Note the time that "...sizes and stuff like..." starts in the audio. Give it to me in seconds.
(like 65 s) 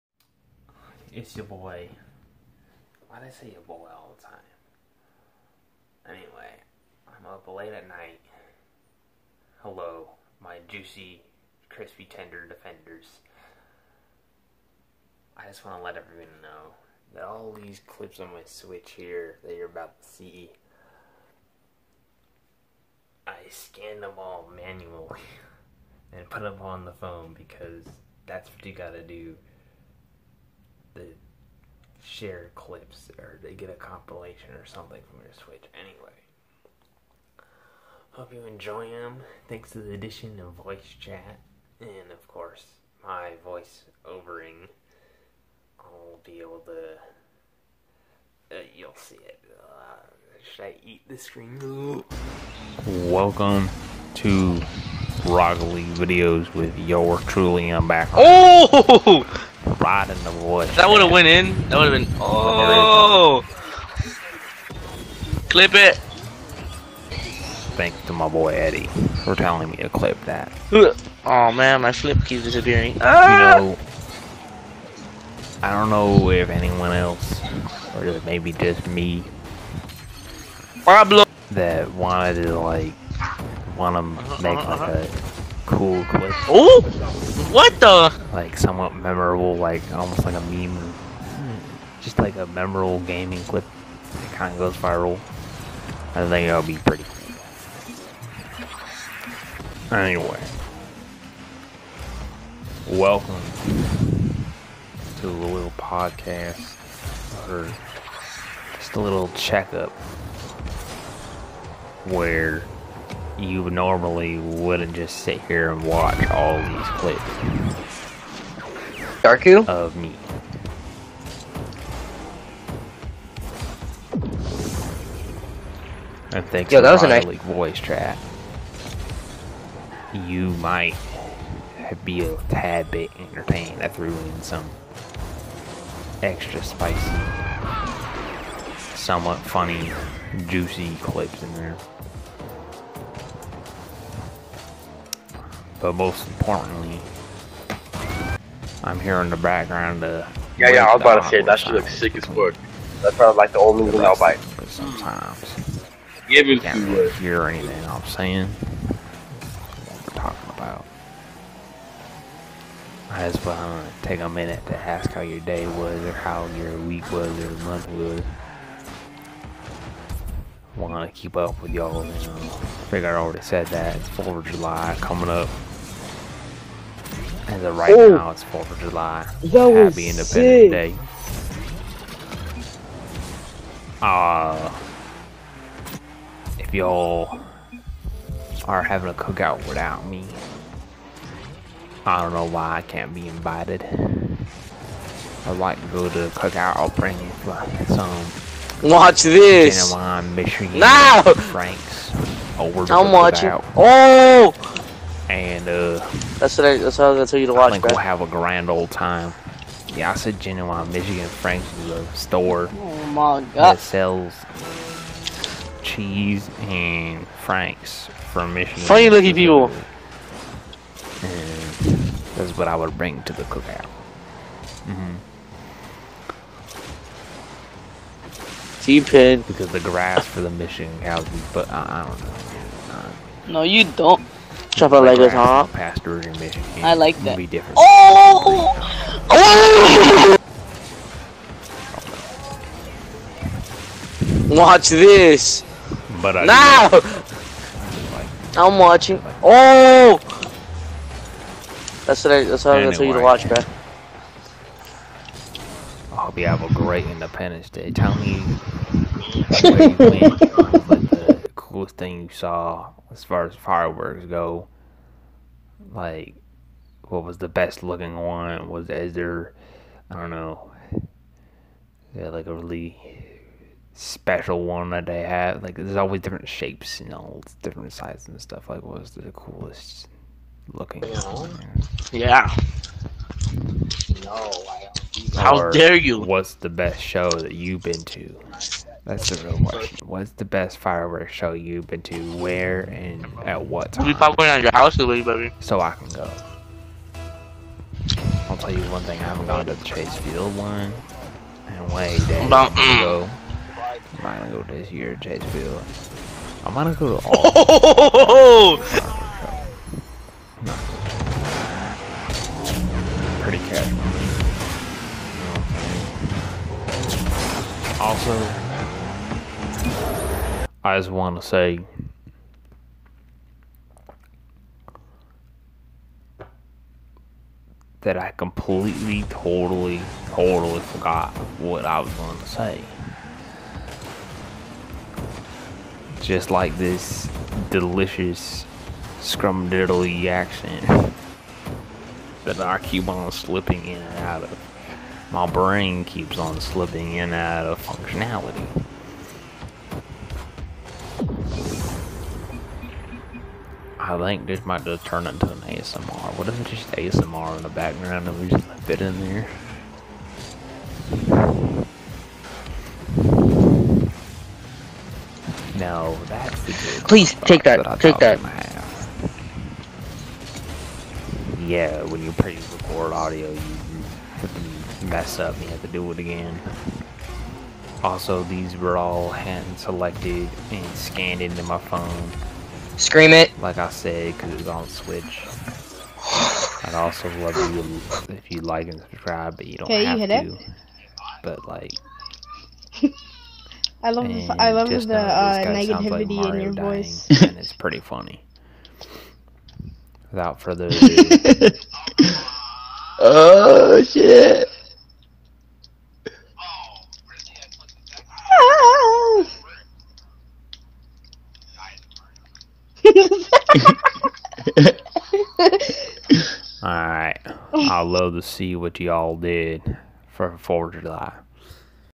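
277 s.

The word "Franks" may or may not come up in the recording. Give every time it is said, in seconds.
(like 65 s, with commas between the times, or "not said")
201 s, 211 s, 217 s.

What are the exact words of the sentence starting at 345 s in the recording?
My brain keeps on slipping in and out of functionality.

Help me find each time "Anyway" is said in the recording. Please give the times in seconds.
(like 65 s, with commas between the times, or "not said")
6 s, 35 s, 99 s.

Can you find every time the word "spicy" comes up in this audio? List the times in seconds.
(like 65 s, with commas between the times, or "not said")
136 s.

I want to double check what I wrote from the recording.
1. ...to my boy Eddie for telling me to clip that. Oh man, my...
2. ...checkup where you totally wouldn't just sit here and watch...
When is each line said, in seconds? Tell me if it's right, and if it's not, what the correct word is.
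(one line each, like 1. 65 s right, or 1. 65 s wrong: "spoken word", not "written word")
1. 68 s right
2. 109 s wrong: "normally", not "totally".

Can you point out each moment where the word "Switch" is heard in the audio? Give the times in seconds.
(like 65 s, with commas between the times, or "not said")
18 s, 35 s, 384 s.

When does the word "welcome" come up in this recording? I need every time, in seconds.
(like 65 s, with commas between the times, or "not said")
53 s, 102 s.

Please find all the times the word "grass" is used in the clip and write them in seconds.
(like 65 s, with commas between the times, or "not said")
229 s.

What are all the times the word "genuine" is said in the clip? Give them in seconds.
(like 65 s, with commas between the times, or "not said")
199 s, 210 s.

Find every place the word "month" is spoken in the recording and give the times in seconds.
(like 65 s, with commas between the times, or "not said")
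167 s.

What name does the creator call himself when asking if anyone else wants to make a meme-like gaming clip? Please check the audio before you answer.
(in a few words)
Pablo.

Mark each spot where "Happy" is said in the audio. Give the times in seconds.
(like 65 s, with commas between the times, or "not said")
179 s.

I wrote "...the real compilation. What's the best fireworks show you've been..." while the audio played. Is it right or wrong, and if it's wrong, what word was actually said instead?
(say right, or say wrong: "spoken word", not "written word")
wrong: "question", not "compilation".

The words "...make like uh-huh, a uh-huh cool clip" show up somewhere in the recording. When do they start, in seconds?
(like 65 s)
84 s.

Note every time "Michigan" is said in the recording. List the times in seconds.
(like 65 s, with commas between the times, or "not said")
200 s, 210 s, 218 s, 230 s.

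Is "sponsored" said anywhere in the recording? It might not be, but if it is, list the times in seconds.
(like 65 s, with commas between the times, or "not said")
not said.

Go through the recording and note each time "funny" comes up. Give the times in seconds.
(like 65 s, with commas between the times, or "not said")
139 s, 218 s, 397 s.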